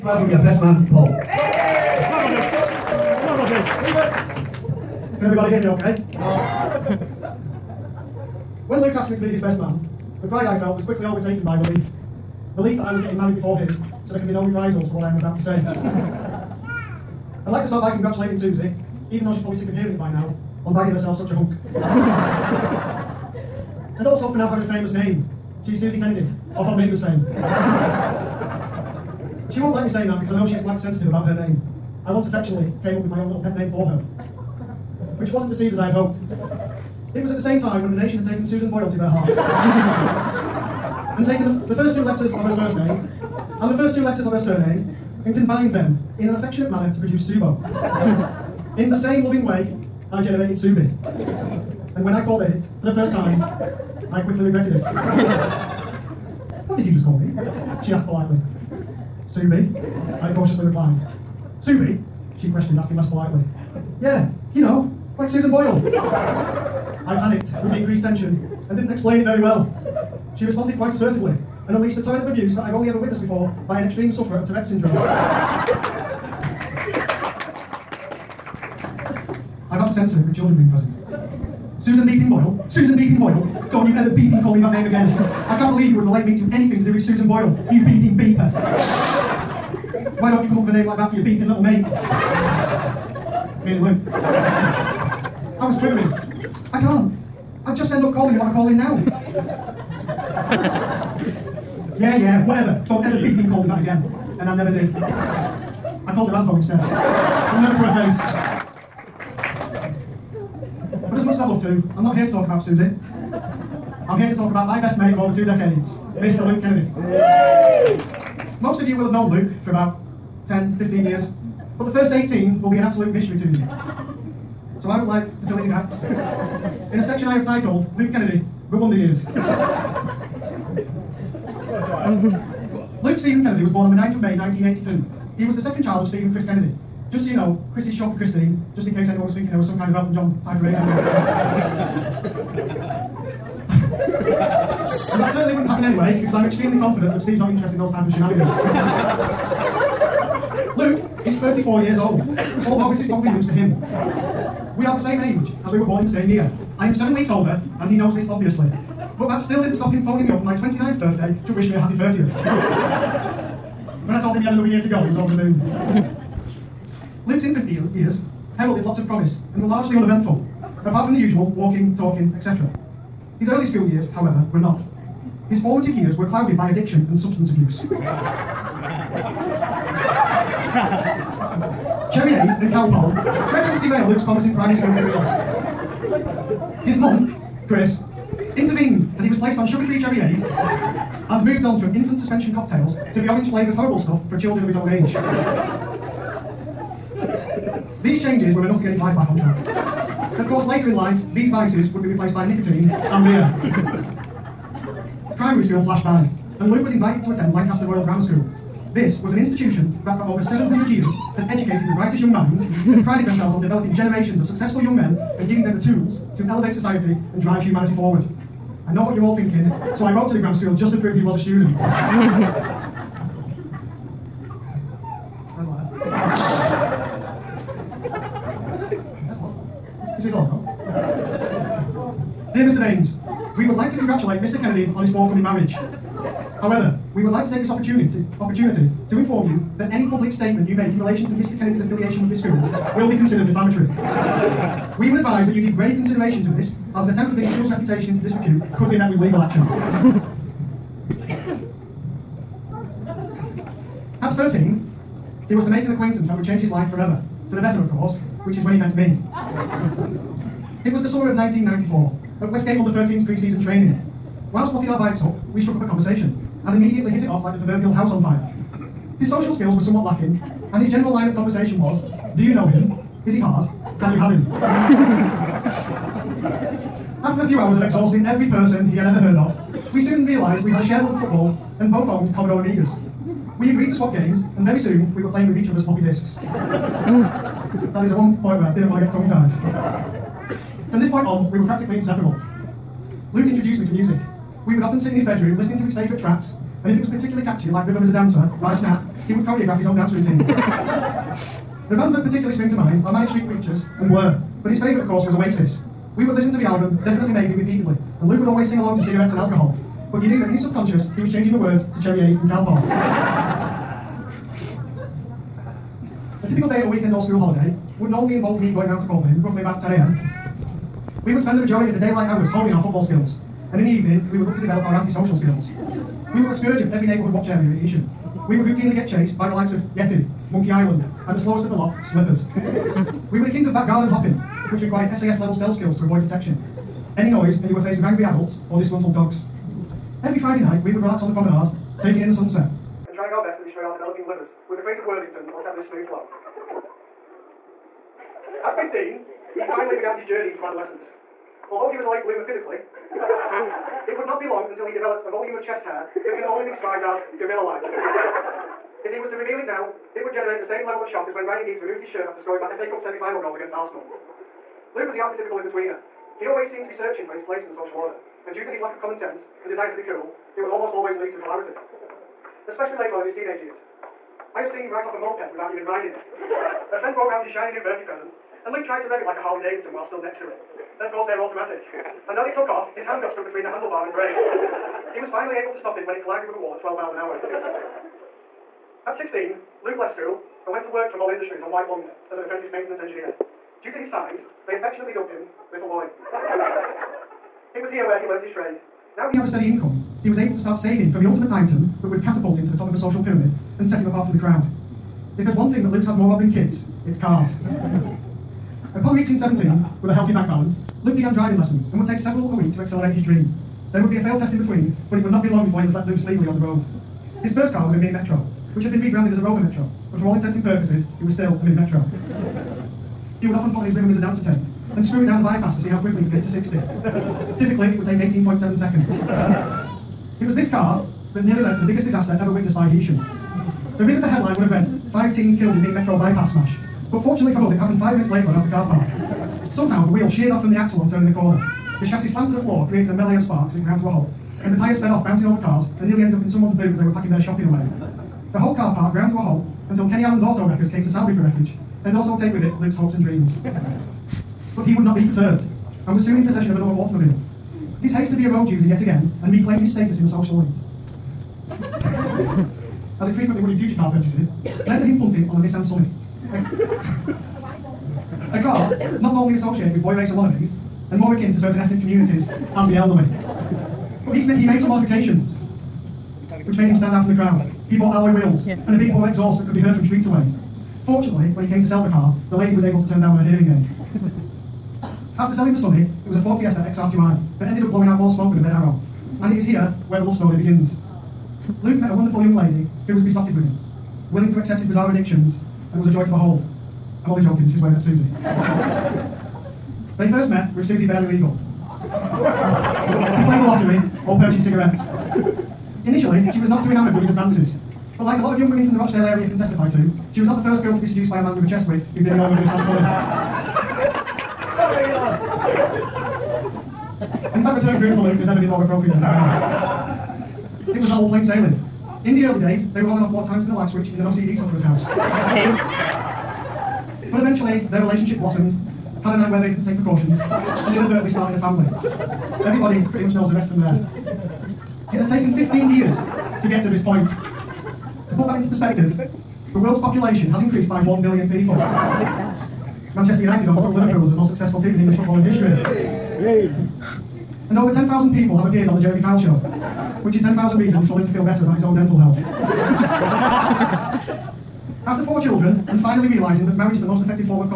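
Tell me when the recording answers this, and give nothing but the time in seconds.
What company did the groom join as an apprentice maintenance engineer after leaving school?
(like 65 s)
391 s.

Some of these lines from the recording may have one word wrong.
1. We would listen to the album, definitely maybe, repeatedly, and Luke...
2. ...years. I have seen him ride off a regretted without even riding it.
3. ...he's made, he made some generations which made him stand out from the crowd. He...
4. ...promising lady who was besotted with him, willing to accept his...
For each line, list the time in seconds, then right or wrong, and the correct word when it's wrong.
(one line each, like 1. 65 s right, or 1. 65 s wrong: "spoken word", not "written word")
1. 306 s right
2. 373 s wrong: "moped", not "regretted"
3. 474 s wrong: "modifications", not "generations"
4. 492 s wrong: "young", not "promising".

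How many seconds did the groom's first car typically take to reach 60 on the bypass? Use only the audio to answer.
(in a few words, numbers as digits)
18.7.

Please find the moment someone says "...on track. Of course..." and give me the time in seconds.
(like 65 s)
199 s.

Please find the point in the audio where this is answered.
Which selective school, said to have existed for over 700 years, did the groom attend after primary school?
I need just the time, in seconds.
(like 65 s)
207 s.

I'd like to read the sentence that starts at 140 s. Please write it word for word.
and that certainly wouldn't happen anyway, because I'm extremely confident that Steve's not interested in those type of shenanigans.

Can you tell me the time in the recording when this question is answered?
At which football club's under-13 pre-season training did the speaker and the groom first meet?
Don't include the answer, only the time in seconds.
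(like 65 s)
262 s.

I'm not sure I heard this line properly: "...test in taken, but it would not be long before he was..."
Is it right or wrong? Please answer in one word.
wrong.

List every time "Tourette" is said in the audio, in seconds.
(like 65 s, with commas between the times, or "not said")
74 s.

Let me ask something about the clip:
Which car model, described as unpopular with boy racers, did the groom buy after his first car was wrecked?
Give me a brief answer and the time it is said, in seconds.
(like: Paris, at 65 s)
Nissan Sunny, at 465 s.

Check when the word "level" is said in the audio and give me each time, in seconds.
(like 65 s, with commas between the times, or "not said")
335 s, 360 s.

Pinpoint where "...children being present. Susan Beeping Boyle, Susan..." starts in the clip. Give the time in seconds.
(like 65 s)
80 s.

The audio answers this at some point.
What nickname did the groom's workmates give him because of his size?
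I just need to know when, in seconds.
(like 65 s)
395 s.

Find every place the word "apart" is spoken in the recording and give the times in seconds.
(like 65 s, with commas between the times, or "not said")
170 s, 404 s.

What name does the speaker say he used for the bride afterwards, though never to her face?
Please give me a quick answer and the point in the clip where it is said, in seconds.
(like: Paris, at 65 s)
Asbo, at 104 s.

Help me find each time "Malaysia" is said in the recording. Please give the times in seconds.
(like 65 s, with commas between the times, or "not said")
not said.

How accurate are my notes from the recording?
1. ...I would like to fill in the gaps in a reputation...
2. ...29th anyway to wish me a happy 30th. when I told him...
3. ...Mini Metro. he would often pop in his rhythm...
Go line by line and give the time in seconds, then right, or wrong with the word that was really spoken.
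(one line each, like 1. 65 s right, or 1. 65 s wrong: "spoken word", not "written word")
1. 124 s wrong: "section", not "reputation"
2. 160 s wrong: "birthday", not "anyway"
3. 421 s right.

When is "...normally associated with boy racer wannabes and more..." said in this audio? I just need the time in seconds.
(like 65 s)
469 s.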